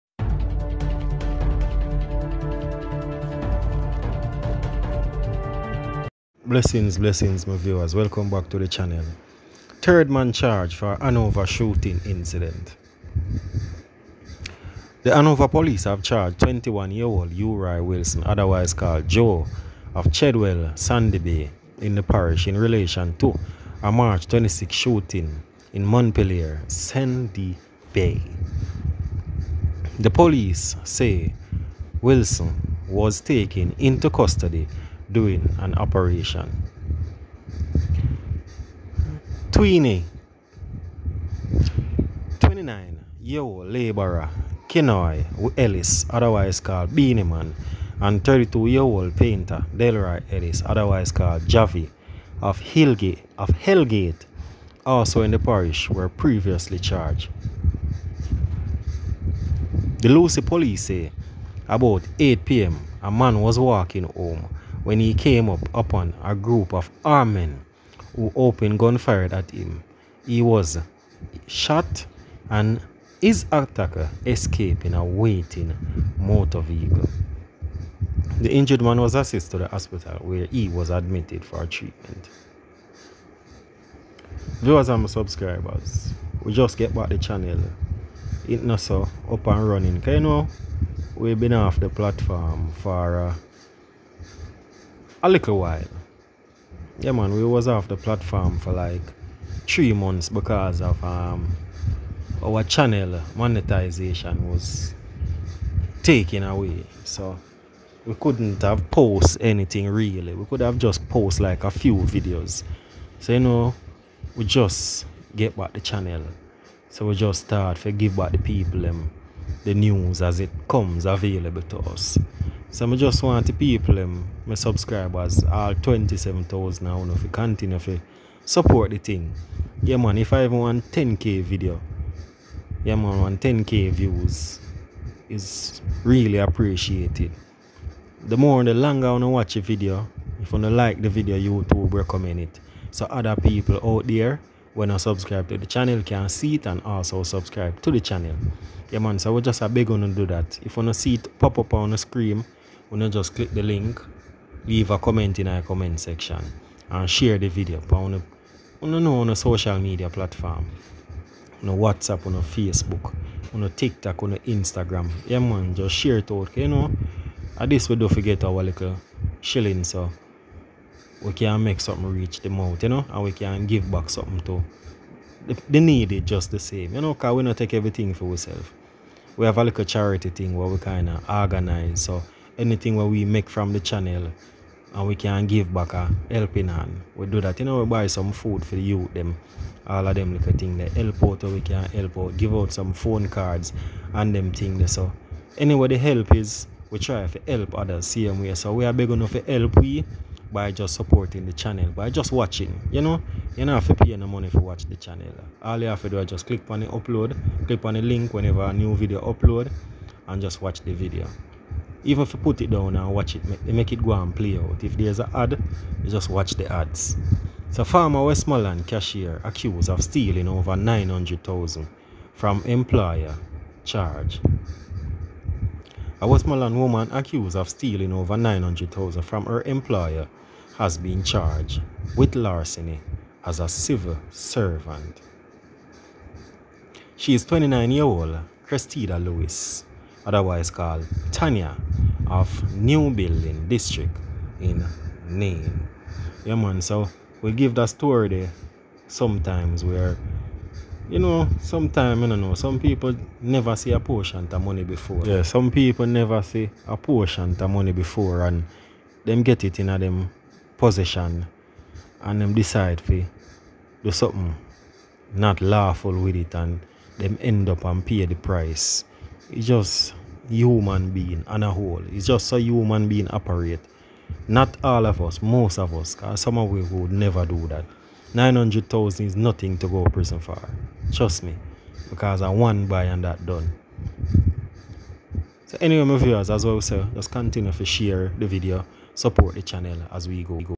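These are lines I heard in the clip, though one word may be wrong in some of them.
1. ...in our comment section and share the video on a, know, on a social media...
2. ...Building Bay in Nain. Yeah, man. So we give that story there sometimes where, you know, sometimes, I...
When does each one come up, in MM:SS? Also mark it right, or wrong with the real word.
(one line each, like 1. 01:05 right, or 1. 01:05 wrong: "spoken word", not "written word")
1. 02:35 right
2. 04:03 wrong: "District", not "Bay".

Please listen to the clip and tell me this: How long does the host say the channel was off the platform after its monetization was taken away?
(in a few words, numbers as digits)
3 months.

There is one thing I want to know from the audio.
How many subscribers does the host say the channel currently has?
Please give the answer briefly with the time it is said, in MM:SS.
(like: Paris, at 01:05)
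27,000, at 02:05.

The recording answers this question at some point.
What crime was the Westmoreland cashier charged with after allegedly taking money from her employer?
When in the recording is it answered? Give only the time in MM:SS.
03:52.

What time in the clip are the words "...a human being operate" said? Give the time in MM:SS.
04:32.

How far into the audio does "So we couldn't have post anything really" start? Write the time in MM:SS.
01:47.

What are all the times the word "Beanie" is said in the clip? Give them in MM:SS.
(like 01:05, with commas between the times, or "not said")
00:46.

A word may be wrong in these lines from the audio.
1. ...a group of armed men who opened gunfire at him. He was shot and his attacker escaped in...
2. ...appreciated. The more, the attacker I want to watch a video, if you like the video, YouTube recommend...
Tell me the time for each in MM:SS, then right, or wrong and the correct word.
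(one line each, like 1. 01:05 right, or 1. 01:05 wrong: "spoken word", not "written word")
1. 01:06 right
2. 02:16 wrong: "longer", not "attacker".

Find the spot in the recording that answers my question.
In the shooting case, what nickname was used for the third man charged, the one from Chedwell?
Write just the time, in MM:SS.
00:19.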